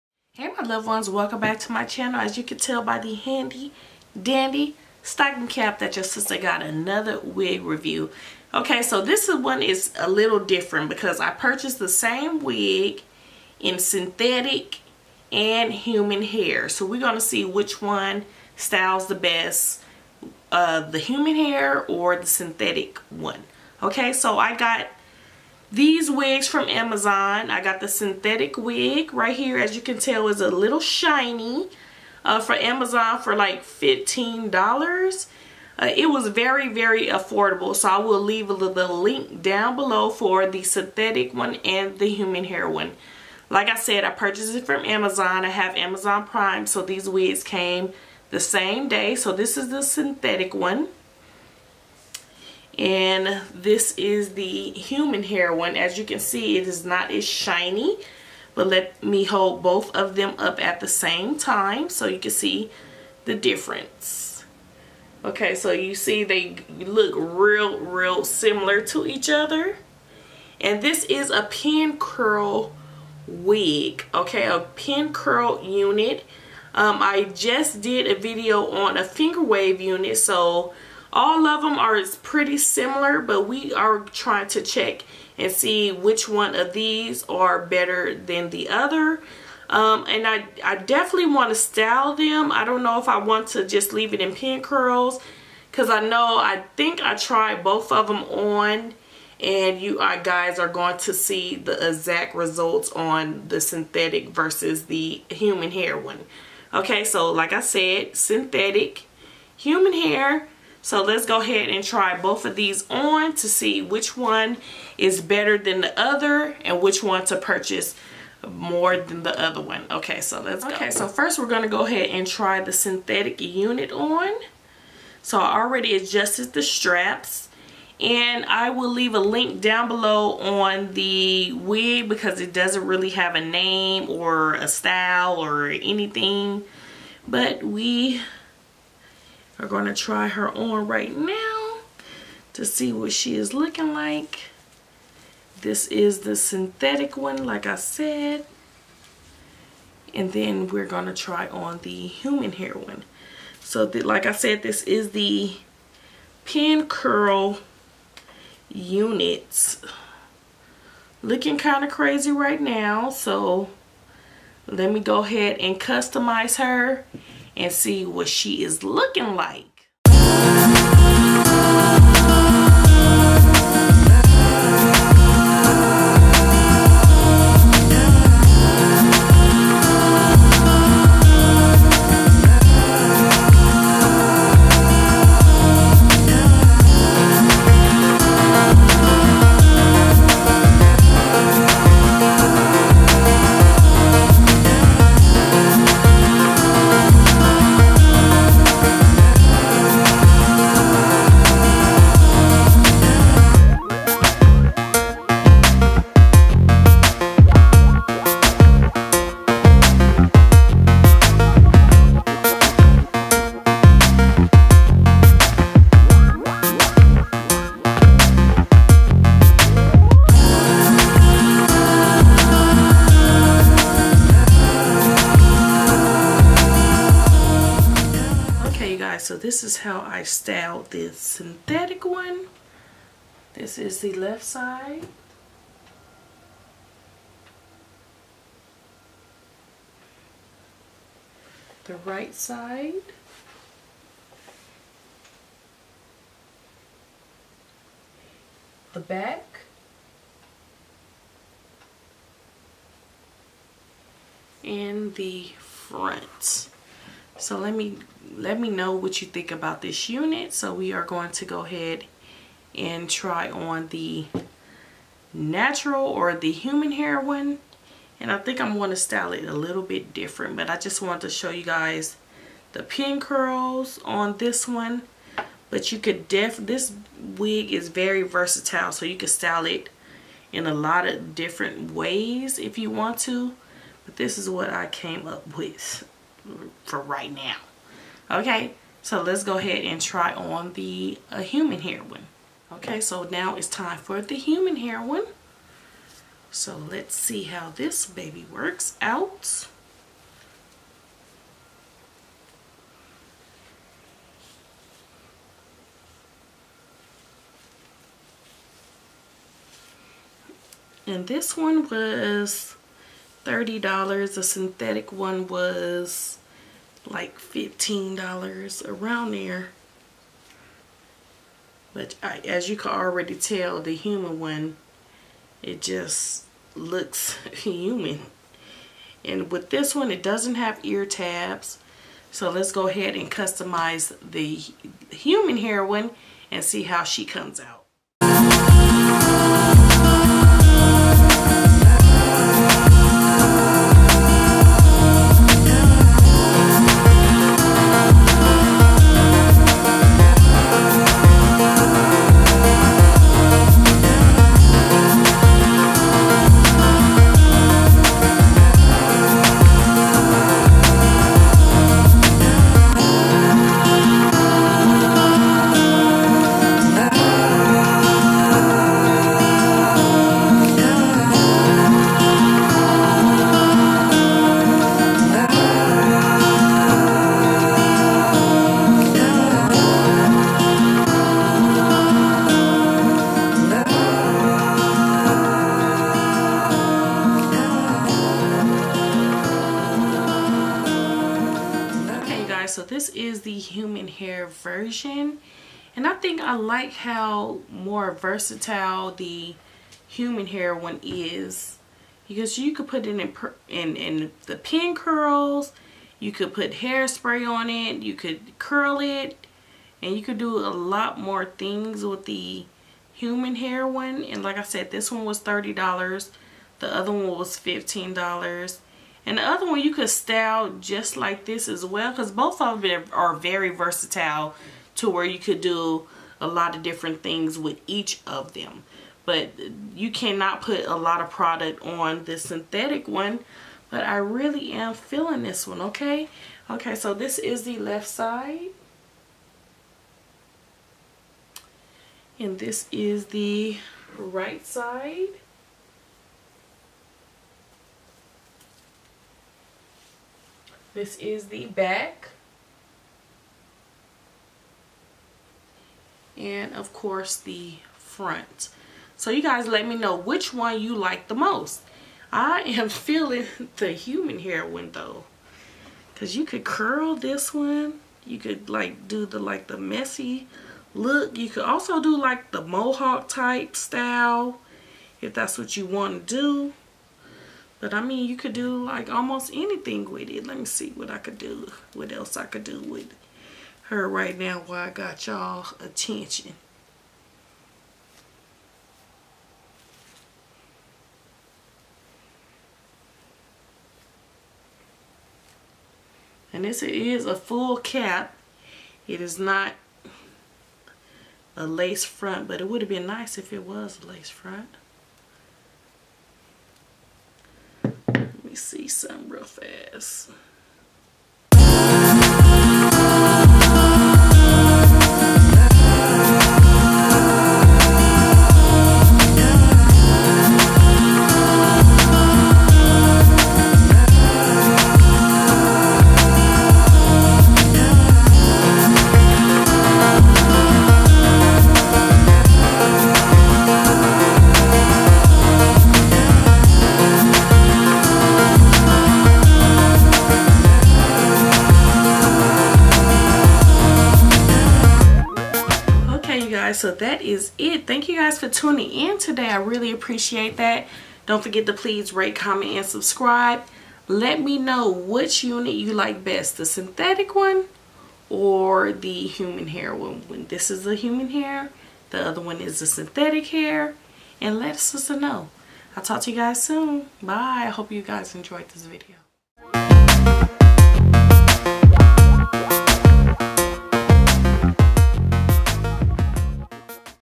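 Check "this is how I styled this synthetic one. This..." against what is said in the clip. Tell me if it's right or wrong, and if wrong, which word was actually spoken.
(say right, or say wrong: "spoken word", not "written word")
right.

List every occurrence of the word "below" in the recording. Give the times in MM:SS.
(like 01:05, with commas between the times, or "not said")
00:39, 02:09.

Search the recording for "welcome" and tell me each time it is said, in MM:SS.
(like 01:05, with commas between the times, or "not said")
00:01.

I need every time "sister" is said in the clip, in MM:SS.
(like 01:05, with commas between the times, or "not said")
00:06.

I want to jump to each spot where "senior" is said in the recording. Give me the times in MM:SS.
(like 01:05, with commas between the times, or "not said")
not said.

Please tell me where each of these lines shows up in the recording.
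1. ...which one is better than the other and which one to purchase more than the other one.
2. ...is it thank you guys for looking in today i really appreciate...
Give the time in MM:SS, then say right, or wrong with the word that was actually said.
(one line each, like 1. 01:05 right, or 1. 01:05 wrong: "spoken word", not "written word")
1. 01:53 right
2. 09:07 wrong: "tuning", not "looking".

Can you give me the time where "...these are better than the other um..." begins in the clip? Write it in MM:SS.
01:26.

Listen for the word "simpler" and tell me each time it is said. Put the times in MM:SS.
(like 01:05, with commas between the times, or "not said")
not said.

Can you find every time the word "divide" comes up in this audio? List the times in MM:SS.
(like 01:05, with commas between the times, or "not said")
not said.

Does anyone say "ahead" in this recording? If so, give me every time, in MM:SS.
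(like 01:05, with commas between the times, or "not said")
01:51, 02:01, 02:45, 04:21, 04:49, 05:32.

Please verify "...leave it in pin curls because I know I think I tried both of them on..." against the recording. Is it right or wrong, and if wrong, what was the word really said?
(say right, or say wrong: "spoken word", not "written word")
right.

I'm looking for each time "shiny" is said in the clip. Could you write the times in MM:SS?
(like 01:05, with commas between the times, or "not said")
00:30, 00:57.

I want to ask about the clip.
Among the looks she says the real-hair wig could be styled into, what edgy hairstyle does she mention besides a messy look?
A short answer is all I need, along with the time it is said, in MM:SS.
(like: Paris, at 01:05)
mohawk, at 07:52.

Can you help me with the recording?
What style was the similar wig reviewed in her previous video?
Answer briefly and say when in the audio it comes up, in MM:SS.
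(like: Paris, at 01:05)
finger wave, at 01:19.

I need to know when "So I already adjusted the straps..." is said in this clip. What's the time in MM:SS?
02:05.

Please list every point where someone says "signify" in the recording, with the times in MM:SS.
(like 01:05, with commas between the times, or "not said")
not said.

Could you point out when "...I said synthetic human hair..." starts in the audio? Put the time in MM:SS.
01:47.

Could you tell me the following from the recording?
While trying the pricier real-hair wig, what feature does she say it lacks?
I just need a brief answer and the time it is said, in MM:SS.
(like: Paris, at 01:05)
ear tabs, at 05:30.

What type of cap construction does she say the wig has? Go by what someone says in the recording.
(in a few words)
full cap.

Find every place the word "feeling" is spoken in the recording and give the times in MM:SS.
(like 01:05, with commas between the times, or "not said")
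07:14, 07:42.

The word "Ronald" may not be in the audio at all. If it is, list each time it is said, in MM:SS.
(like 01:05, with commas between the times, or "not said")
not said.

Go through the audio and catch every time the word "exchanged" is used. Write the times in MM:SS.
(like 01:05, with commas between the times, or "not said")
not said.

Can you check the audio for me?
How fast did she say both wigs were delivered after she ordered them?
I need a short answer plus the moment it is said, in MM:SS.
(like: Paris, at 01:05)
same day, at 00:48.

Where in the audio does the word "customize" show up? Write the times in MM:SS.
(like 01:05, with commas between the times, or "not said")
02:45, 05:33.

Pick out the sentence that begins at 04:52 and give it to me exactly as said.
Okay, so now it's time for the human hair one.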